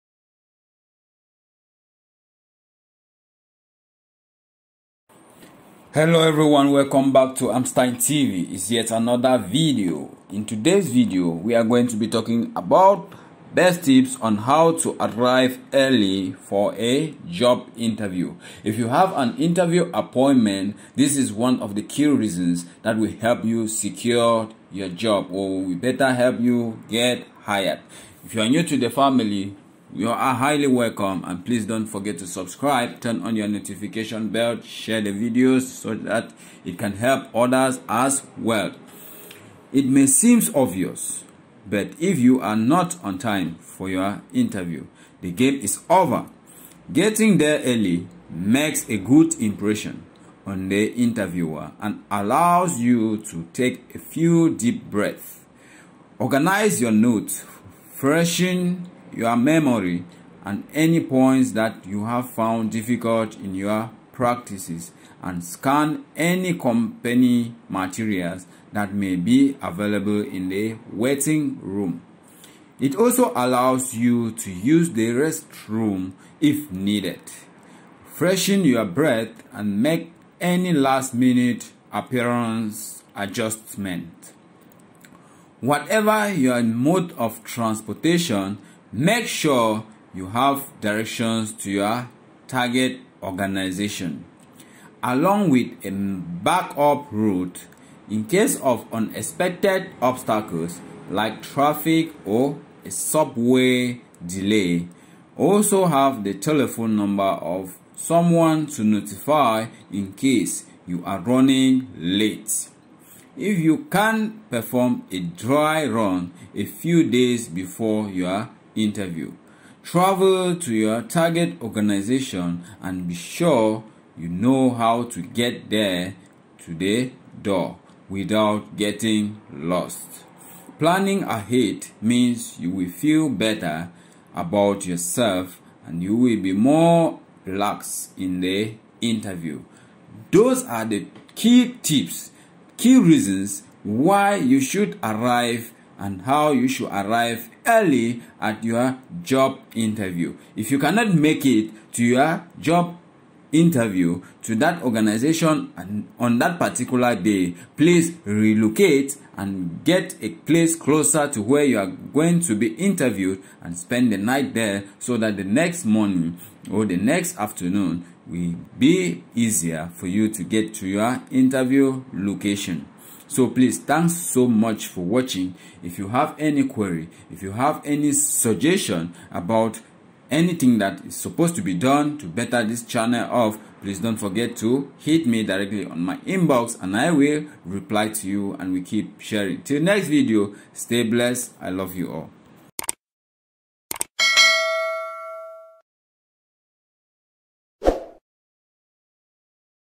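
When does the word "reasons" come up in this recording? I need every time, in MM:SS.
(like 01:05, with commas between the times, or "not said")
00:22, 02:22.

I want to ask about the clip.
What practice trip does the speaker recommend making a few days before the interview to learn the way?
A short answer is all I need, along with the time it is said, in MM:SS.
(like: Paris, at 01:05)
dry run, at 01:55.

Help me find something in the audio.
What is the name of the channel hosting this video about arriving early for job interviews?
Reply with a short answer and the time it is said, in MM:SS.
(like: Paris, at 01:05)
Emstine TV, at 00:07.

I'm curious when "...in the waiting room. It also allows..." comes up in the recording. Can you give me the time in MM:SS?
01:10.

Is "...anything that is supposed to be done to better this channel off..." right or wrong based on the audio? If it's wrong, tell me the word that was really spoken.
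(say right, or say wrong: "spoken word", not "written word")
right.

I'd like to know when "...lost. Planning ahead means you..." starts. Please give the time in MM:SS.
02:09.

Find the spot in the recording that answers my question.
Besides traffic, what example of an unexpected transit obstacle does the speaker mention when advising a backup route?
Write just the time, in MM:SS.
01:42.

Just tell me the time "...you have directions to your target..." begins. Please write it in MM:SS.
01:30.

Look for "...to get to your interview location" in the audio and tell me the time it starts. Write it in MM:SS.
02:50.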